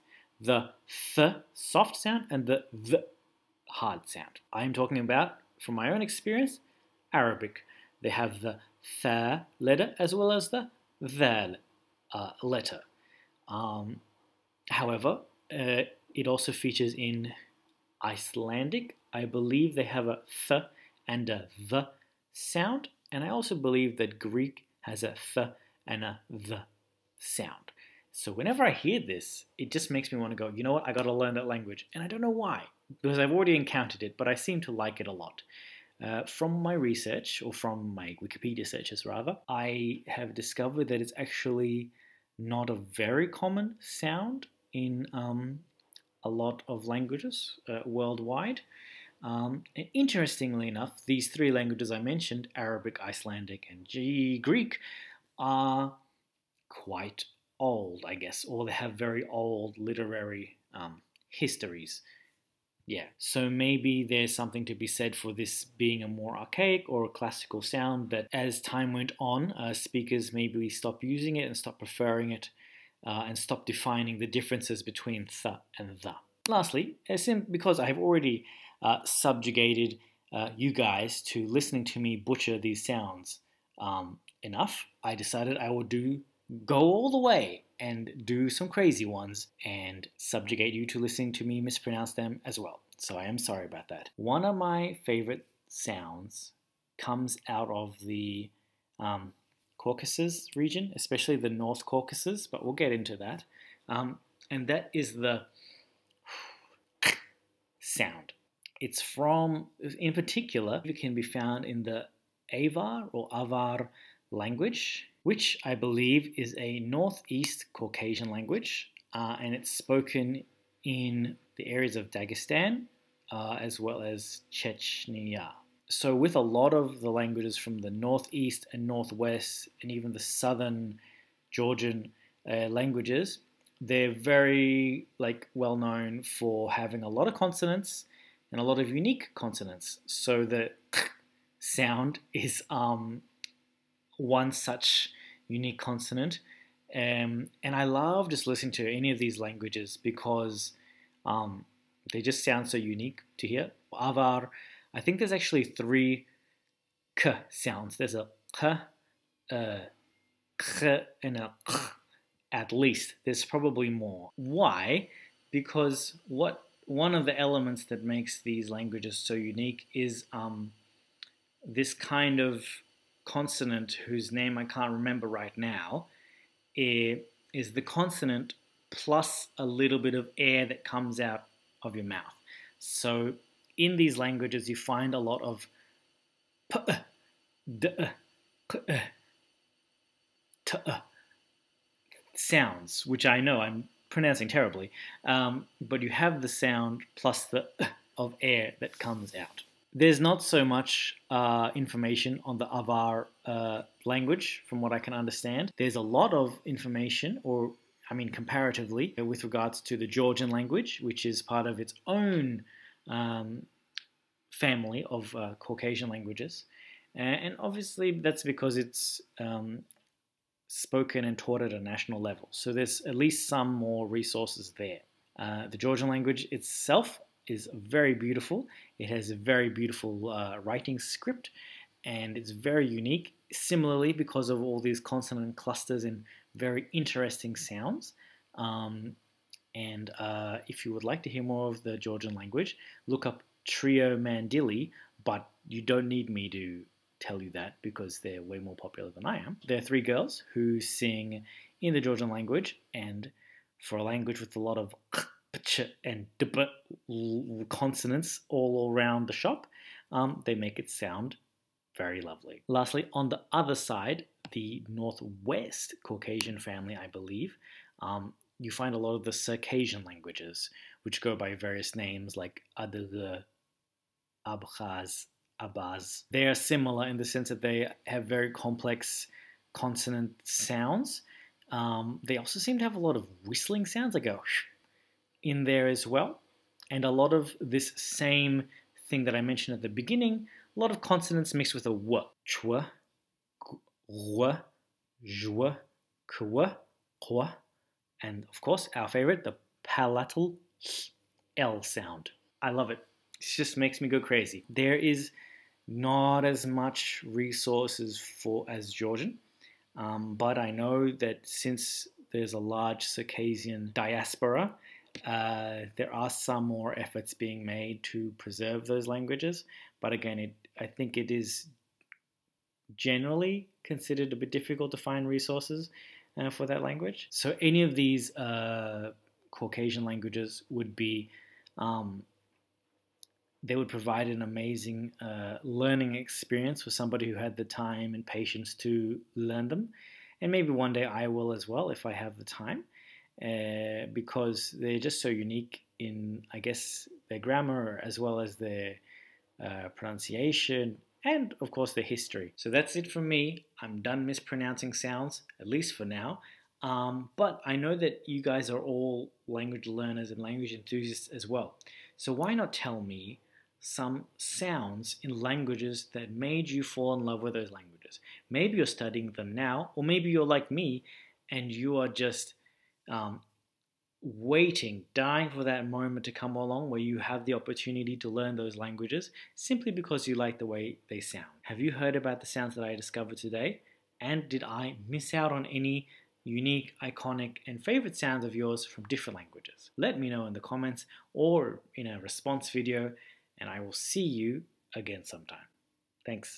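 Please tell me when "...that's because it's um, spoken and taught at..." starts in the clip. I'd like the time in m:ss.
3:38.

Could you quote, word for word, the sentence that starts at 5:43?
Uh, because they're just so unique in, I guess, their grammar as well as their uh, pronunciation and, of course, their history.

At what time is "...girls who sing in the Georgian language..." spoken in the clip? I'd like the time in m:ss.
4:10.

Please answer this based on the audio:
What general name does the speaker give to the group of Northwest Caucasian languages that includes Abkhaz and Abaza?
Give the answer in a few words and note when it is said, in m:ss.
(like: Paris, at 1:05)
Circassian languages, at 4:29.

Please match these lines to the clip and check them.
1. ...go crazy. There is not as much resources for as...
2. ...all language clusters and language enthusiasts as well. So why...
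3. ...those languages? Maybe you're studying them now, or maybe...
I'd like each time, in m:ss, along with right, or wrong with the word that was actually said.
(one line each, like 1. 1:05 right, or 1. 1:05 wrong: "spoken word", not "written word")
1. 5:04 right
2. 5:58 wrong: "learners", not "clusters"
3. 6:07 right.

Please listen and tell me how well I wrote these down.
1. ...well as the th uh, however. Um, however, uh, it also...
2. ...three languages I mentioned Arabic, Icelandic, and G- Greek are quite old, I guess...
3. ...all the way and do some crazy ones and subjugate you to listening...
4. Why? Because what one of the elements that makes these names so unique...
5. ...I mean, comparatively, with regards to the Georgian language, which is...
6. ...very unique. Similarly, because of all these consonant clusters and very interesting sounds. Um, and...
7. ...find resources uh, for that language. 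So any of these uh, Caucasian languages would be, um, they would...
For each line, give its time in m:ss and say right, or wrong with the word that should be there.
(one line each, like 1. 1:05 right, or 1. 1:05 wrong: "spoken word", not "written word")
1. 0:10 wrong: "letter", not "however"
2. 0:51 right
3. 1:26 right
4. 2:44 wrong: "languages", not "names"
5. 3:28 right
6. 3:52 right
7. 5:24 right.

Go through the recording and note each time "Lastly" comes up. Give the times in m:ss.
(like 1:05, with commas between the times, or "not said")
1:16, 4:22.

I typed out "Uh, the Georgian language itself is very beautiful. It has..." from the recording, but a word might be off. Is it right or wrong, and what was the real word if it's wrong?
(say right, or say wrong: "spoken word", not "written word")
right.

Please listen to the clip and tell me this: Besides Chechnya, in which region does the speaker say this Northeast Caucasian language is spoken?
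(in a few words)
Dagestan.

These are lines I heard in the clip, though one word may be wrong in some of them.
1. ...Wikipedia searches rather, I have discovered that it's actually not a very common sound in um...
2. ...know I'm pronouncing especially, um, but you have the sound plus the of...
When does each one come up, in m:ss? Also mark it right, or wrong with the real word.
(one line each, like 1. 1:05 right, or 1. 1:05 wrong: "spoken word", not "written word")
1. 0:38 right
2. 3:13 wrong: "terribly", not "especially".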